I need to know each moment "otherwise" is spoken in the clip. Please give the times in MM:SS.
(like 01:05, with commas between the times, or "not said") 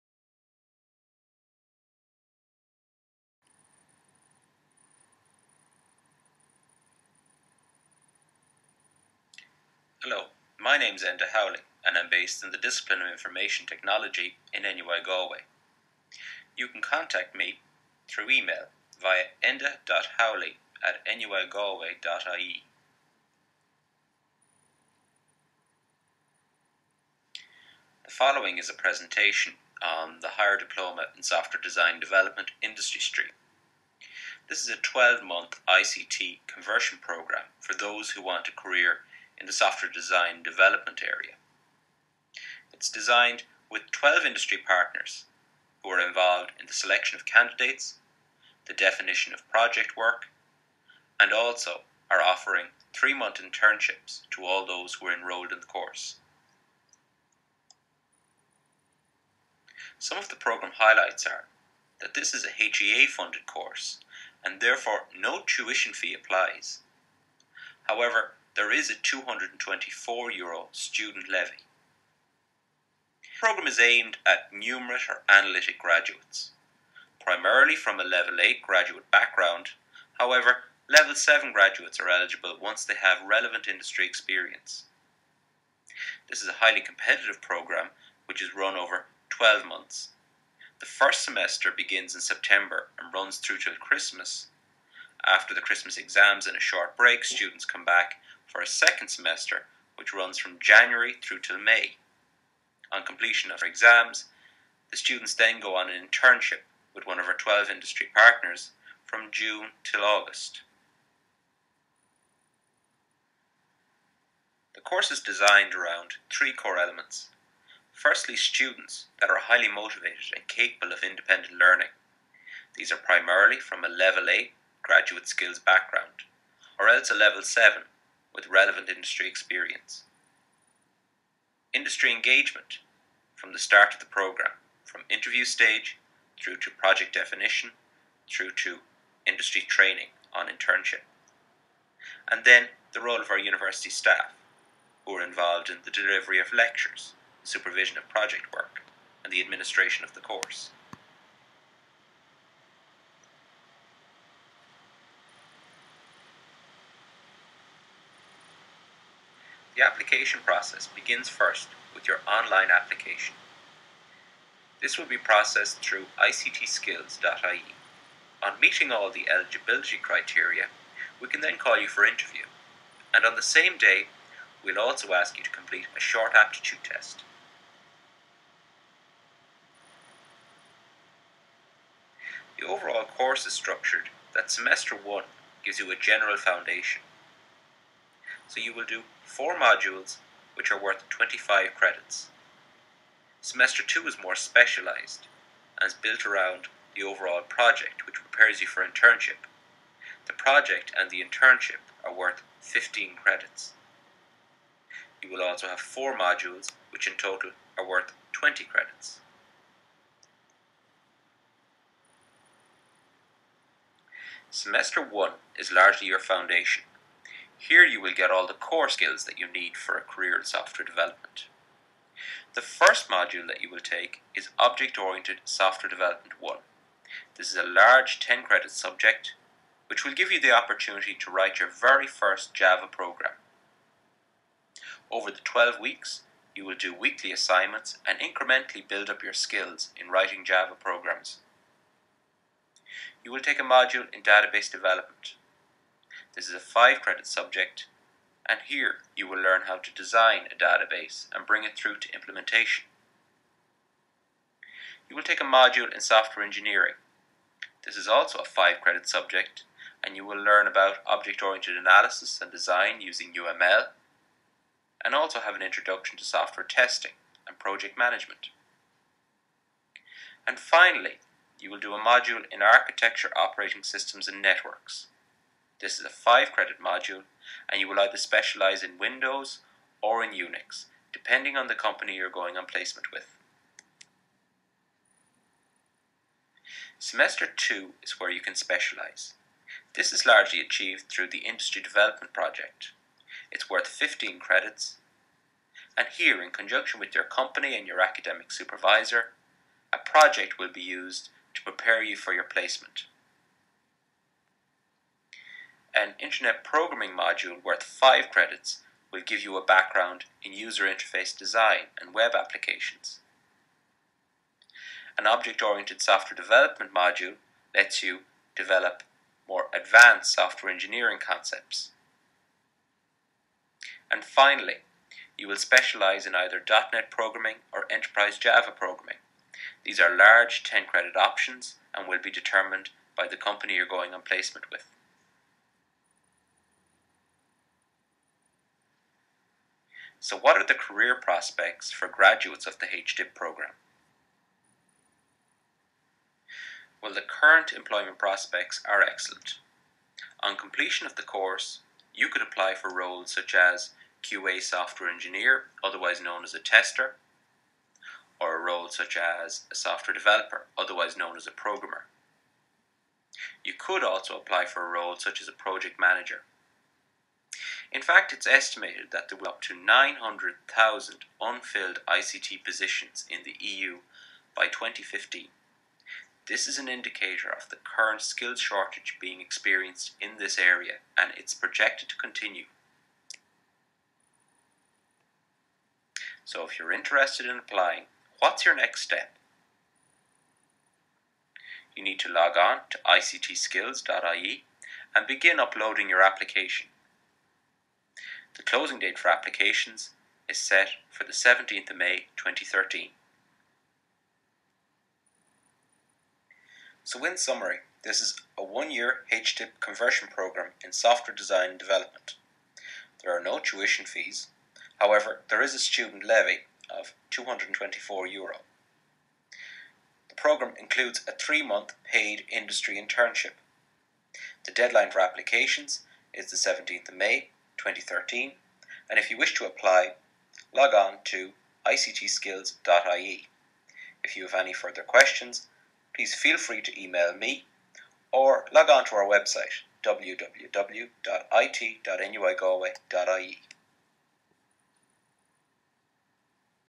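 05:55, 06:00.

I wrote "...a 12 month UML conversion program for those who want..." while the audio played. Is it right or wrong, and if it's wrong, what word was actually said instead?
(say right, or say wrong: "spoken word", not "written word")
wrong: "ICT", not "UML".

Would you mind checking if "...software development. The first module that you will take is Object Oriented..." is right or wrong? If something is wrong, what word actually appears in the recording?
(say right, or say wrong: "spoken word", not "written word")
right.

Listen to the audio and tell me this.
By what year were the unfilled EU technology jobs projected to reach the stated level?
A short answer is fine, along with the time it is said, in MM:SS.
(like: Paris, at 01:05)
2015, at 06:14.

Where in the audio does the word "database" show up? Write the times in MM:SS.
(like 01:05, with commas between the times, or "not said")
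04:04, 04:10.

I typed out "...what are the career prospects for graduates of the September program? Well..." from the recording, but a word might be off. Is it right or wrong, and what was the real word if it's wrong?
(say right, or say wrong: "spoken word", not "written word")
wrong: "HDIP", not "September".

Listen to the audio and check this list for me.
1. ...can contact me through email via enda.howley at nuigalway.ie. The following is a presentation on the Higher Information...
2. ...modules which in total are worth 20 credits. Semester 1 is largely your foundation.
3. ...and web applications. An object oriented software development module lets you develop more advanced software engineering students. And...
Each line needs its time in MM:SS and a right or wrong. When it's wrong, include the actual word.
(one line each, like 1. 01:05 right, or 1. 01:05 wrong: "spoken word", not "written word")
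1. 00:16 wrong: "Diploma", not "Information"
2. 03:26 right
3. 05:11 wrong: "concepts", not "students".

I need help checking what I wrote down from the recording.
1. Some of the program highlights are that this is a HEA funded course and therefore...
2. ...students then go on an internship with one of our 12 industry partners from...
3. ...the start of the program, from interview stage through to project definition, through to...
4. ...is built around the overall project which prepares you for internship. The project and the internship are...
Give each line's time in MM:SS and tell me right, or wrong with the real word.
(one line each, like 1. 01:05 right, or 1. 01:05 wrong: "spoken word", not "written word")
1. 00:59 right
2. 01:44 right
3. 02:13 right
4. 03:15 right.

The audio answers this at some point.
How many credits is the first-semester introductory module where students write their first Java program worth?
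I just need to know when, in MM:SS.
03:48.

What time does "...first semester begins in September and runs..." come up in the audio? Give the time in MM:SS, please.
01:30.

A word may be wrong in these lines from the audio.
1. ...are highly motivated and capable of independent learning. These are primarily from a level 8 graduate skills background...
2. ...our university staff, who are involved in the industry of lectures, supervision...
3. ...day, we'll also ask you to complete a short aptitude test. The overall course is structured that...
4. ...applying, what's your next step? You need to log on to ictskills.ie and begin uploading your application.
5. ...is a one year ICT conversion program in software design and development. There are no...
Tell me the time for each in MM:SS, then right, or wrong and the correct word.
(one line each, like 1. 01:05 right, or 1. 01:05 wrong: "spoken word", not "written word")
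1. 01:59 right
2. 02:23 wrong: "delivery", not "industry"
3. 02:53 right
4. 06:27 right
5. 06:48 wrong: "HDIP", not "ICT".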